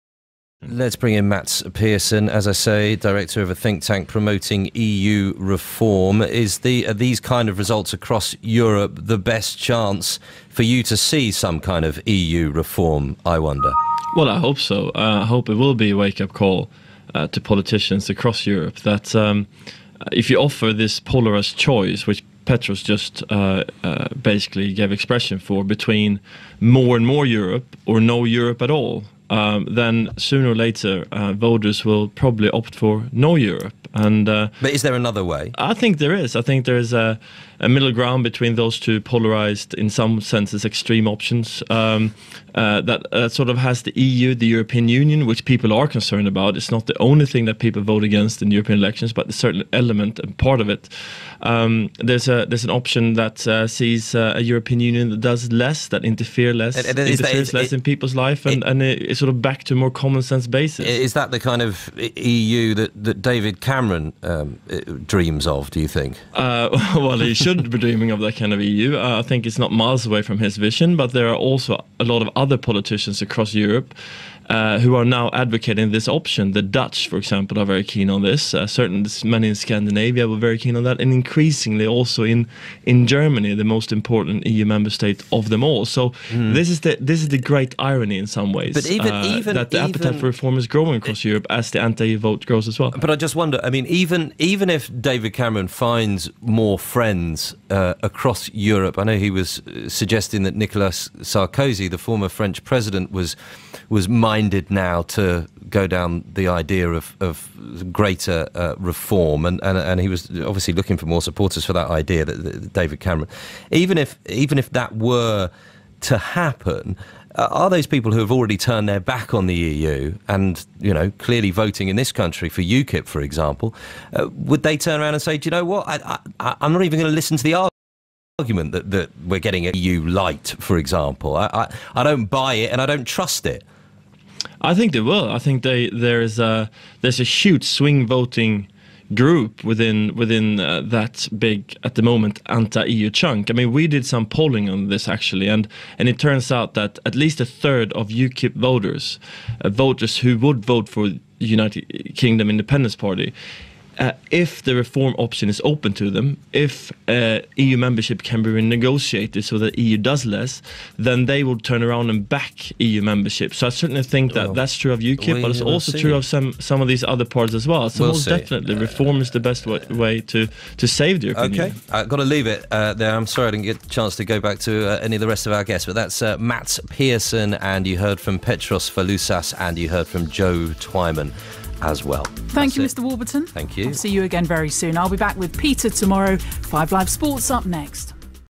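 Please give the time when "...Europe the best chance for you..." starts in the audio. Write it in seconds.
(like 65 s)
8 s.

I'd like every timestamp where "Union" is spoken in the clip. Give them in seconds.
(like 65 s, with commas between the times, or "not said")
44 s, 54 s, 171 s.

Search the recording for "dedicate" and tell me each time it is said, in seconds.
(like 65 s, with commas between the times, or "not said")
not said.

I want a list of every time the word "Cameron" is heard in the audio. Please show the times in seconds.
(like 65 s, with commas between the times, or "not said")
63 s, 95 s, 112 s.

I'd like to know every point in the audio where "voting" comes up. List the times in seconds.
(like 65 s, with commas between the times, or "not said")
121 s, 138 s.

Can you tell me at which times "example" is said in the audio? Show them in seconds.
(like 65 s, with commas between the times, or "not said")
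77 s, 123 s, 130 s.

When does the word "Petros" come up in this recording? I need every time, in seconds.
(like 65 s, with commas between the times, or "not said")
22 s, 178 s.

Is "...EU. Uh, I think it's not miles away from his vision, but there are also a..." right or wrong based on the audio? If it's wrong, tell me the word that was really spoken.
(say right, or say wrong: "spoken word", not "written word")
right.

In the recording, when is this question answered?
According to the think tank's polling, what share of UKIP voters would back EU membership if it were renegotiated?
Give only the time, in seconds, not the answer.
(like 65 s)
147 s.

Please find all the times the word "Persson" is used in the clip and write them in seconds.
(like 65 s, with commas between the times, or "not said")
1 s, 176 s.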